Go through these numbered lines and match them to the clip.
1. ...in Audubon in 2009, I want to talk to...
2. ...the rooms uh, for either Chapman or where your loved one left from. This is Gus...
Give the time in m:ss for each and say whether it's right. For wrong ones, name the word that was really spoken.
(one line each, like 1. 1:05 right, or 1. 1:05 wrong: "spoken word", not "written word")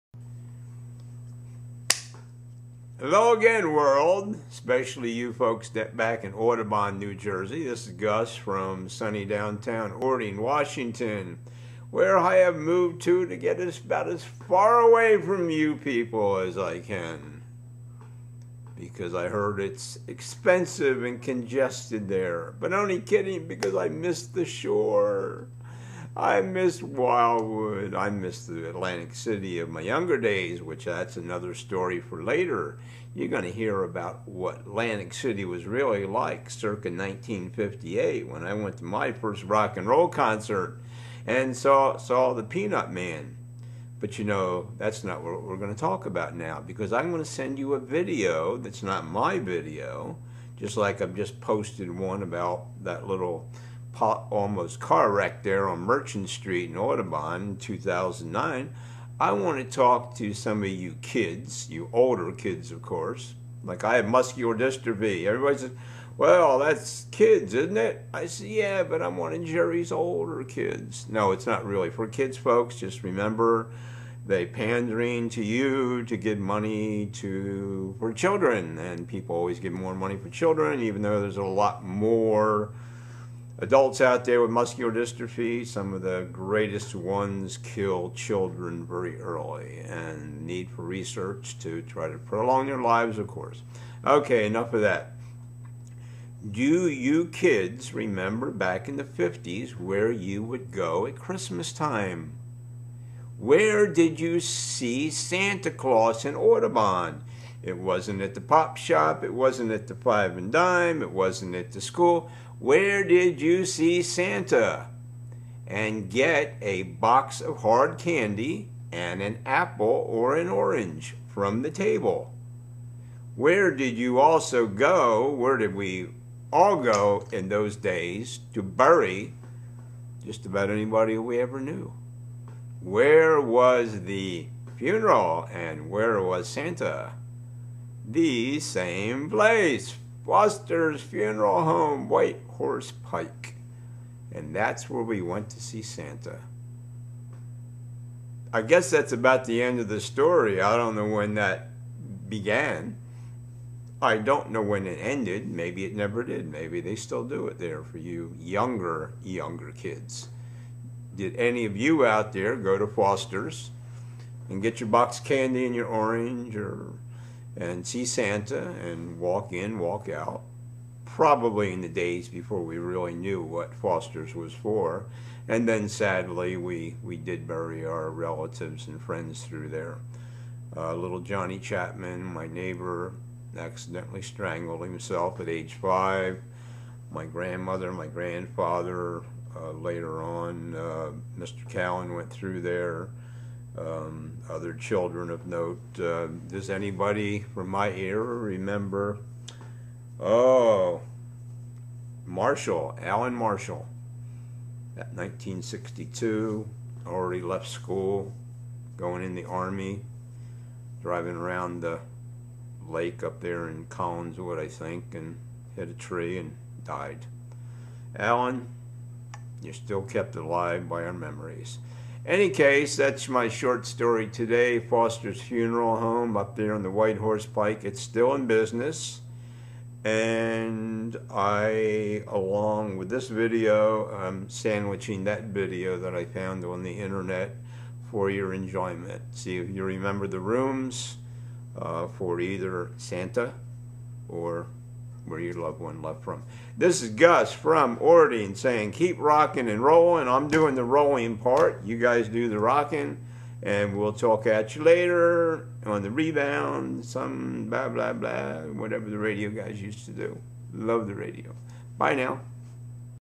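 1. 0:56 right
2. 4:00 wrong: "Santa", not "Chapman".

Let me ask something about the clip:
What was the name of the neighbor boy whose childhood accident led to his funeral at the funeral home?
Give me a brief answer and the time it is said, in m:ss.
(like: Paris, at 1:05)
Johnny Chapman, at 3:01.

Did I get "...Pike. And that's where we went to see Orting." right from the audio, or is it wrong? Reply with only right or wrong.
wrong.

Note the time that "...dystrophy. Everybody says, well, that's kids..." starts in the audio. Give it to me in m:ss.
1:04.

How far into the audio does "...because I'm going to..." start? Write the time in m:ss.
0:46.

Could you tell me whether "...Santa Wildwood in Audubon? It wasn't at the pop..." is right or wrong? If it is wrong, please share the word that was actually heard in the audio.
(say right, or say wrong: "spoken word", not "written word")
wrong: "Claus", not "Wildwood".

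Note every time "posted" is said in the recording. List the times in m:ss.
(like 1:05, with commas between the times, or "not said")
0:51.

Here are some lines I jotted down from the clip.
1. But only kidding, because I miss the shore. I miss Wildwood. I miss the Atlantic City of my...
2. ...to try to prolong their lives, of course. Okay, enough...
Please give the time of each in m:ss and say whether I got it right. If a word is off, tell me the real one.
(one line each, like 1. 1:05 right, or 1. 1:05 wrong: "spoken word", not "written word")
1. 0:22 right
2. 1:31 right.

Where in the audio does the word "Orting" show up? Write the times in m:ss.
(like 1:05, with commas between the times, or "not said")
0:09, 4:08.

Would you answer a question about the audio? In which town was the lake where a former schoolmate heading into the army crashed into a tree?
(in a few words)
Collingswood.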